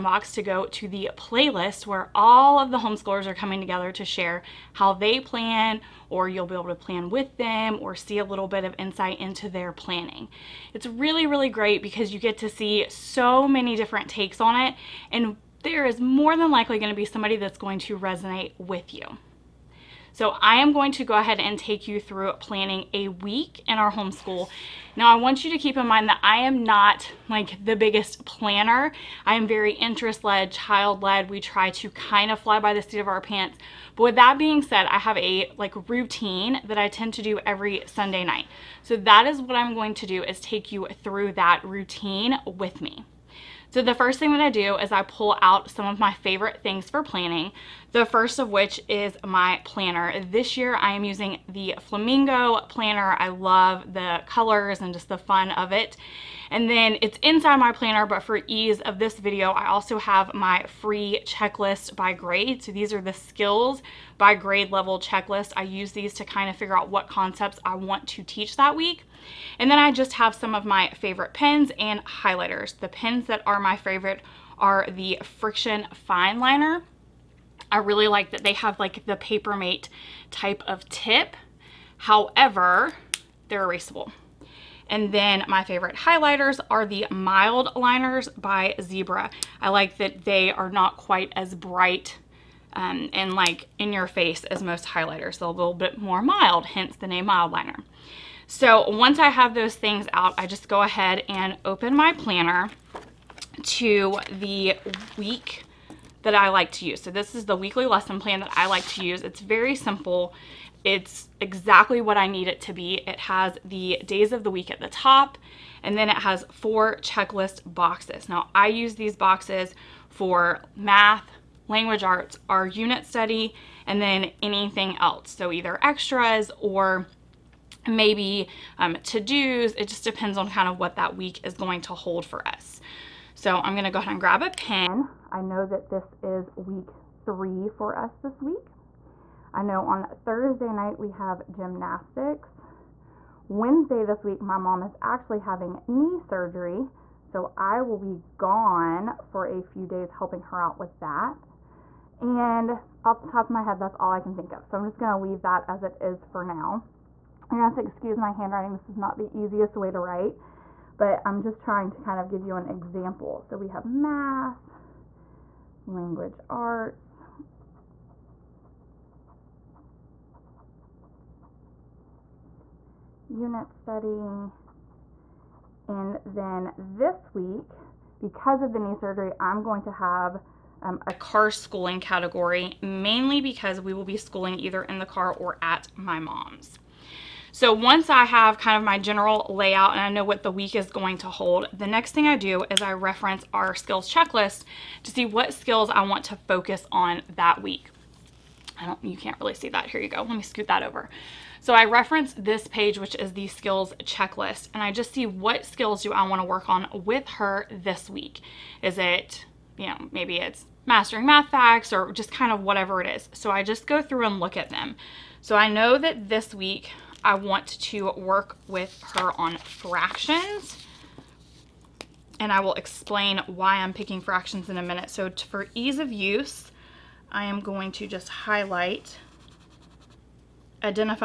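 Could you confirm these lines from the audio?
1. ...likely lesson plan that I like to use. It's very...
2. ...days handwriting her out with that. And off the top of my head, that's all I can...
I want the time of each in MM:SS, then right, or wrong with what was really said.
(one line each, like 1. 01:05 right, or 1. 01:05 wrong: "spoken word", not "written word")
1. 01:47 wrong: "weekly", not "likely"
2. 02:29 wrong: "helping", not "handwriting".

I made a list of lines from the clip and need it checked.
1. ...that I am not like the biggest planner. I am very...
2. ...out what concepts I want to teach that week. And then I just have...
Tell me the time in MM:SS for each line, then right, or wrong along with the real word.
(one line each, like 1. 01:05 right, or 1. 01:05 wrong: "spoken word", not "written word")
1. 00:26 right
2. 01:06 right.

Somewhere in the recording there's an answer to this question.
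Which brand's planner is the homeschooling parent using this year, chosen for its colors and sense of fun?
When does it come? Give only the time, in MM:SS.
00:51.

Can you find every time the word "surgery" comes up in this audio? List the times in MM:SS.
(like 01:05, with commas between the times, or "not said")
02:26, 02:58.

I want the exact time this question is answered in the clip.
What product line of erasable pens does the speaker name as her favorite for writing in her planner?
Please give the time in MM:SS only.
01:15.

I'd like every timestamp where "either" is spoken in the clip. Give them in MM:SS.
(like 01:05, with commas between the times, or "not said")
02:05, 03:04.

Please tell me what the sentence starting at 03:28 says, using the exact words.
Is it, you know, maybe it's mastering math facts or just kind of whatever it is.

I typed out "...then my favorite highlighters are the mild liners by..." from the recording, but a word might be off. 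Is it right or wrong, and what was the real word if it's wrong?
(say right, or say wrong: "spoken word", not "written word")
right.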